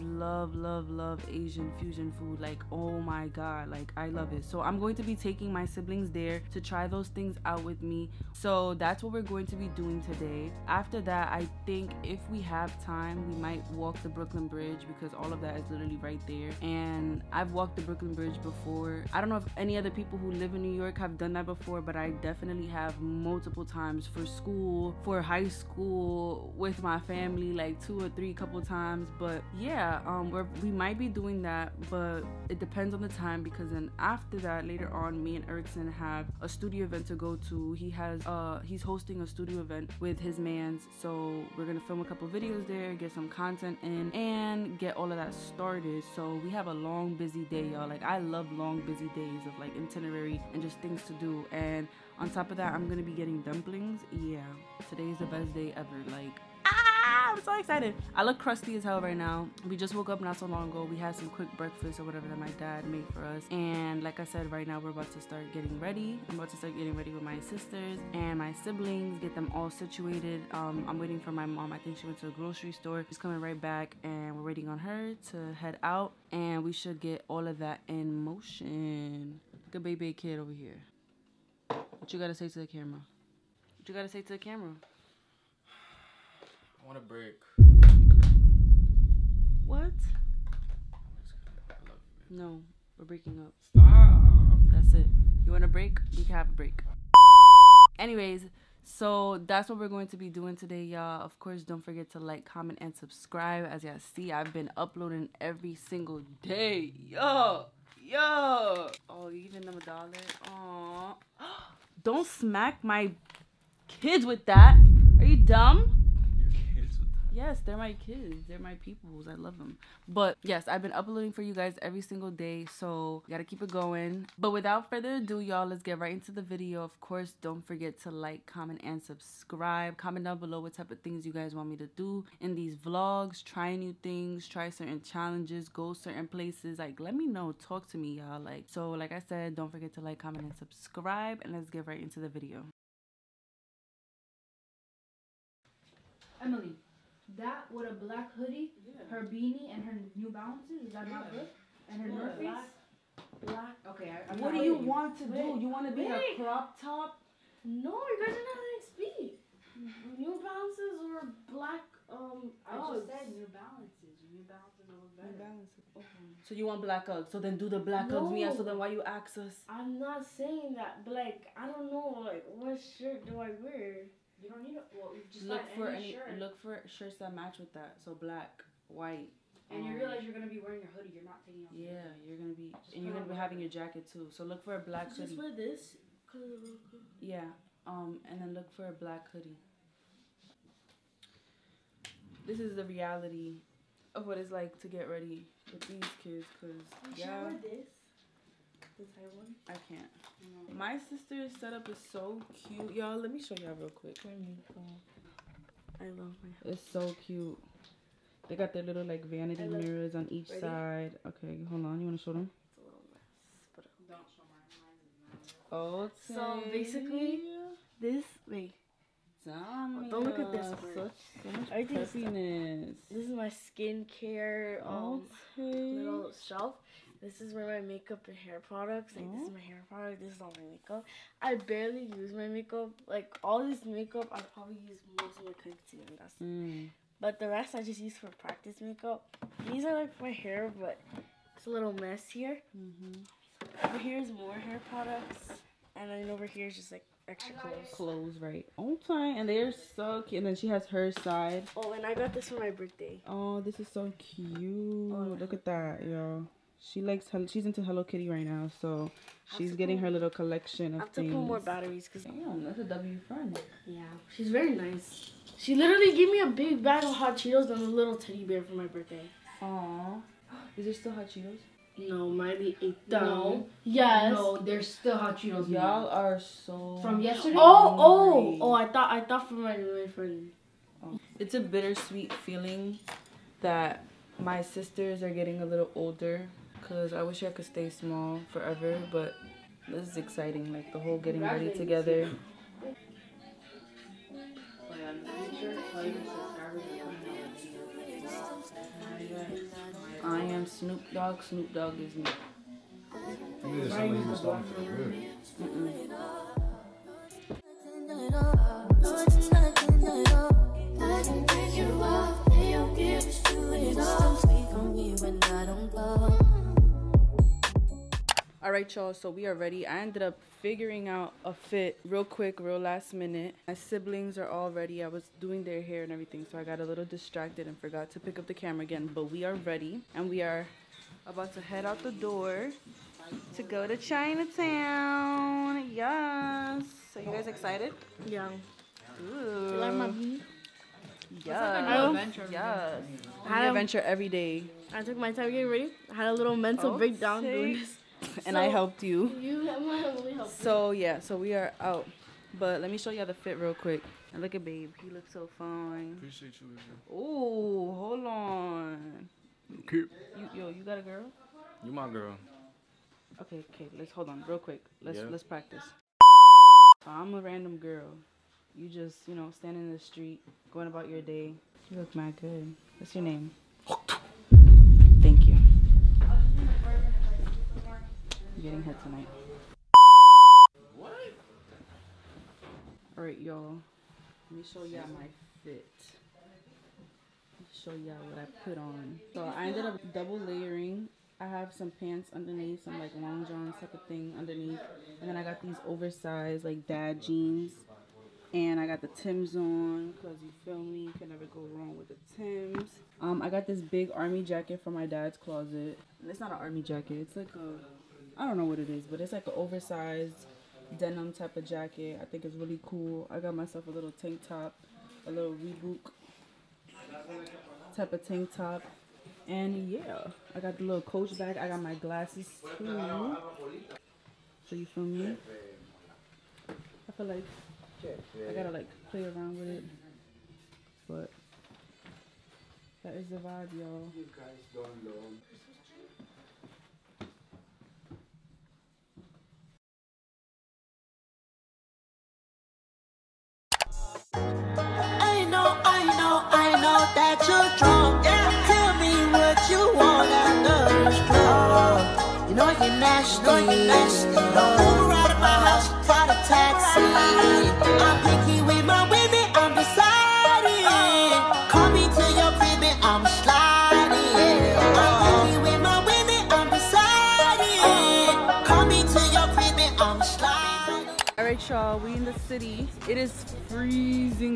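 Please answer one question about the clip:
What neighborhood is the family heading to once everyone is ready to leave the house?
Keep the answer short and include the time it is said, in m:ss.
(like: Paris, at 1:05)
Chinatown, at 5:33.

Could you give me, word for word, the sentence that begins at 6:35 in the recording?
And then I got these oversized like dad jeans.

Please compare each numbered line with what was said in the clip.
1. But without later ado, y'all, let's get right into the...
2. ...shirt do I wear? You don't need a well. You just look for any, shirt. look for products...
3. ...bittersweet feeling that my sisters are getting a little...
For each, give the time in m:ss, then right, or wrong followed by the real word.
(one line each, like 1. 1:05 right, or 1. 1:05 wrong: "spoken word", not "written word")
1. 2:04 wrong: "further", not "later"
2. 2:52 wrong: "shirts", not "products"
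3. 4:41 right.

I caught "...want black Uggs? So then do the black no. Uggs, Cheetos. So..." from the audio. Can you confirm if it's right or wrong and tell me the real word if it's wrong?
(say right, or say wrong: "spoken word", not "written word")
wrong: "Mia", not "Cheetos".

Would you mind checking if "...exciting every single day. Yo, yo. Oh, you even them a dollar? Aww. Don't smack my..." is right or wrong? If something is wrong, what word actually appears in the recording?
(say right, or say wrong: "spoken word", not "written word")
wrong: "uploading", not "exciting".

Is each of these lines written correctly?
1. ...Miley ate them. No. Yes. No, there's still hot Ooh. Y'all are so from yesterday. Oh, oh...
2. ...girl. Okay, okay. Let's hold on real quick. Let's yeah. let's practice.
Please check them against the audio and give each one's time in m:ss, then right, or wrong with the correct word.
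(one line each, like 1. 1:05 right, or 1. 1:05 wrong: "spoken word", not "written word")
1. 4:32 wrong: "Cheetos", not "Ooh"
2. 6:02 right.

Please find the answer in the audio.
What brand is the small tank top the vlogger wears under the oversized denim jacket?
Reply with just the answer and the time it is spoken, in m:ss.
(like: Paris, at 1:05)
Reebok, at 6:55.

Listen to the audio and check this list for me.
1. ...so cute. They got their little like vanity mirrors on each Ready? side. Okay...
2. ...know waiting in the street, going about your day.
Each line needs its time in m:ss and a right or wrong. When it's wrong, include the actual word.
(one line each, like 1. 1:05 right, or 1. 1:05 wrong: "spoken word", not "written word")
1. 3:26 right
2. 6:09 wrong: "standing", not "waiting".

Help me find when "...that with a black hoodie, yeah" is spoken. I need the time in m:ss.
2:27.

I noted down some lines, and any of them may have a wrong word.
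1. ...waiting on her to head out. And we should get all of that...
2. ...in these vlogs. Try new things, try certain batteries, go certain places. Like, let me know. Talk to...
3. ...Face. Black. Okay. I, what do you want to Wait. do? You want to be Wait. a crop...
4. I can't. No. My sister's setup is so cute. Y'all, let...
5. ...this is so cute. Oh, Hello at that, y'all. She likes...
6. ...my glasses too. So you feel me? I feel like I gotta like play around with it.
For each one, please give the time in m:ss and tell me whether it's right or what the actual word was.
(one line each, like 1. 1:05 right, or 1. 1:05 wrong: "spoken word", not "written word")
1. 1:14 right
2. 2:12 wrong: "challenges", not "batteries"
3. 2:32 right
4. 3:19 right
5. 4:13 wrong: "Look", not "Hello"
6. 7:01 right.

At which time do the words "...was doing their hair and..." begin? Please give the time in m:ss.
5:25.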